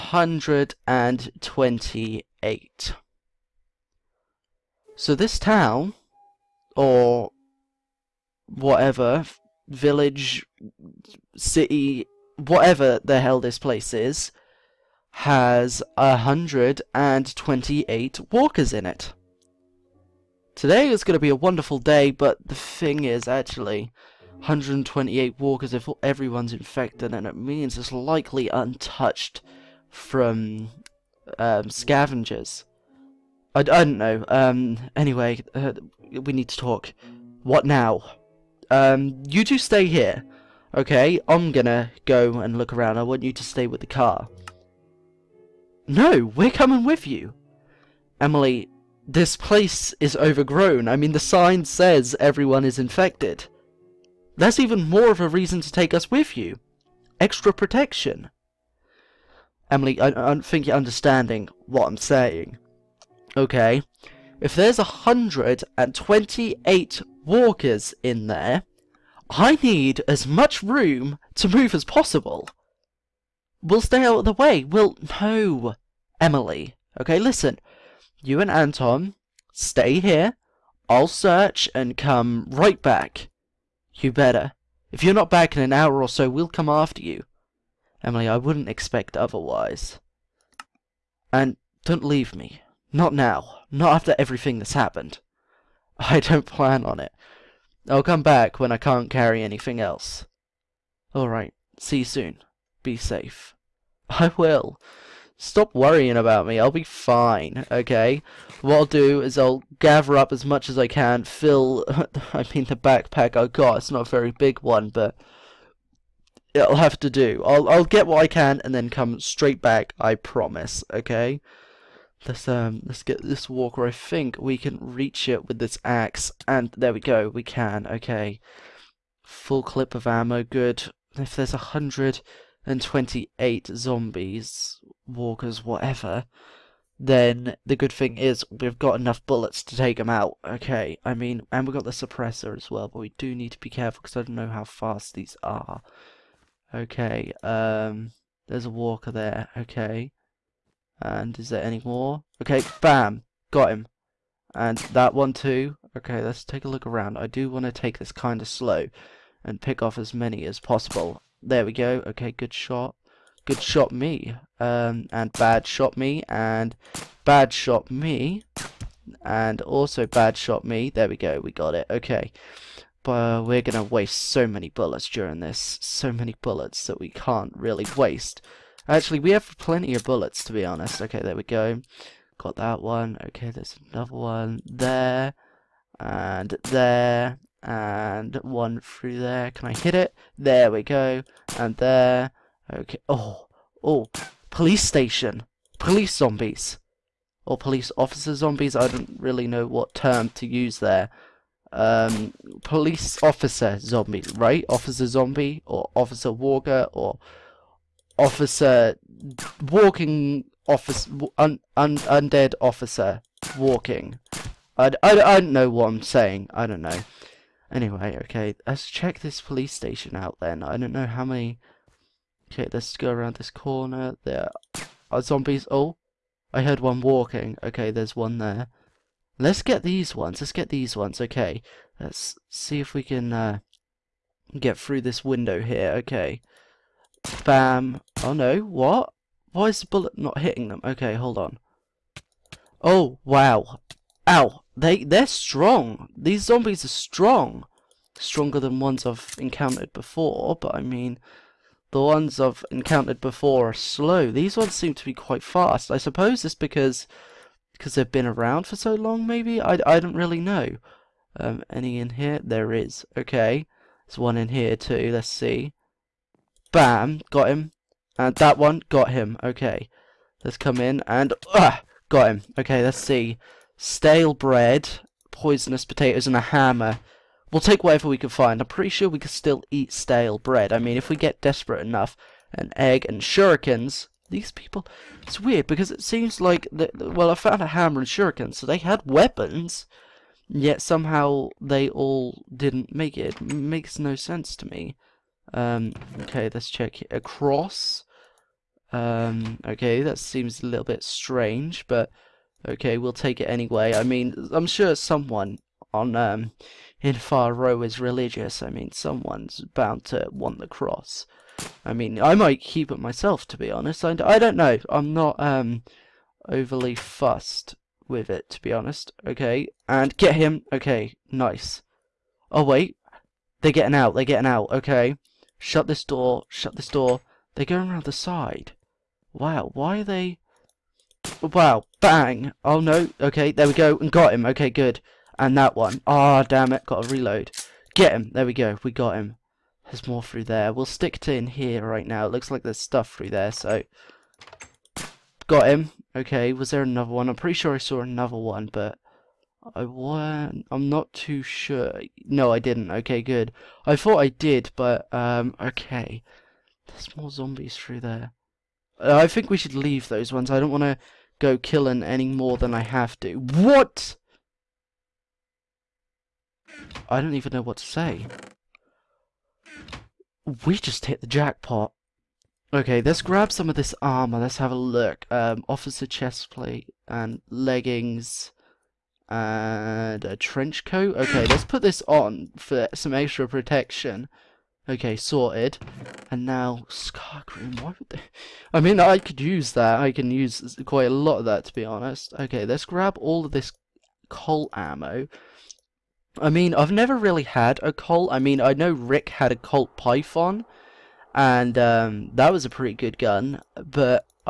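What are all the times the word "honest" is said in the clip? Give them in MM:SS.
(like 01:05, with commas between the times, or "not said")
03:00, 05:13, 05:18, 06:31.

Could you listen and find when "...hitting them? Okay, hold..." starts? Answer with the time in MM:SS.
04:00.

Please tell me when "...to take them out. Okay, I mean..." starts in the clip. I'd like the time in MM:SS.
02:19.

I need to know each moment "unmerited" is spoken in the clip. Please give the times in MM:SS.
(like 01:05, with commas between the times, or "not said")
not said.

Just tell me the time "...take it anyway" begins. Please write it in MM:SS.
05:03.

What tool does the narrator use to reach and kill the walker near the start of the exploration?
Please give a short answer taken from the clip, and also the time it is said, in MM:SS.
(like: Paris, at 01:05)
axe, at 02:05.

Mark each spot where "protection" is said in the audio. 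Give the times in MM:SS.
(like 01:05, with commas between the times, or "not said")
00:57, 06:23.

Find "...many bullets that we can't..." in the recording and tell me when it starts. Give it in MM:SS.
02:56.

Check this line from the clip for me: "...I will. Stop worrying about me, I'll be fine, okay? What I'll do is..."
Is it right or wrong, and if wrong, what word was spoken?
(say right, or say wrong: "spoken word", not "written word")
right.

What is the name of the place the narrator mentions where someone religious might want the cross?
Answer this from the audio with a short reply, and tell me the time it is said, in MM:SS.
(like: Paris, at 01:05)
Far Row, at 05:07.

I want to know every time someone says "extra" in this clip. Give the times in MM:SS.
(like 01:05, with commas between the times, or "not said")
00:57, 06:23.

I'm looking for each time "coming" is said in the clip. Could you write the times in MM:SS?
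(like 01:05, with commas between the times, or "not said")
00:46.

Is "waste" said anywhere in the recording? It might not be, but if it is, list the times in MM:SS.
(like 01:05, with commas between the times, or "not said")
02:53, 02:57.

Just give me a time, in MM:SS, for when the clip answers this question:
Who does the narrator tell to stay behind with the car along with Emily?
01:18.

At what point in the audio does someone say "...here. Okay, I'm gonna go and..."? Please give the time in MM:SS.
00:39.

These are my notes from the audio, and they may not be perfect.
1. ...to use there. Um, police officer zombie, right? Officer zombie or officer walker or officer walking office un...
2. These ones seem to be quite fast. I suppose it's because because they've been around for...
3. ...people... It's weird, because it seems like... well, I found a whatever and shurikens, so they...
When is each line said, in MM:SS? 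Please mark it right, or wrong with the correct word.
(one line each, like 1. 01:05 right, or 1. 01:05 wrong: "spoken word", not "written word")
1. 03:20 right
2. 04:14 right
3. 04:44 wrong: "hammer", not "whatever".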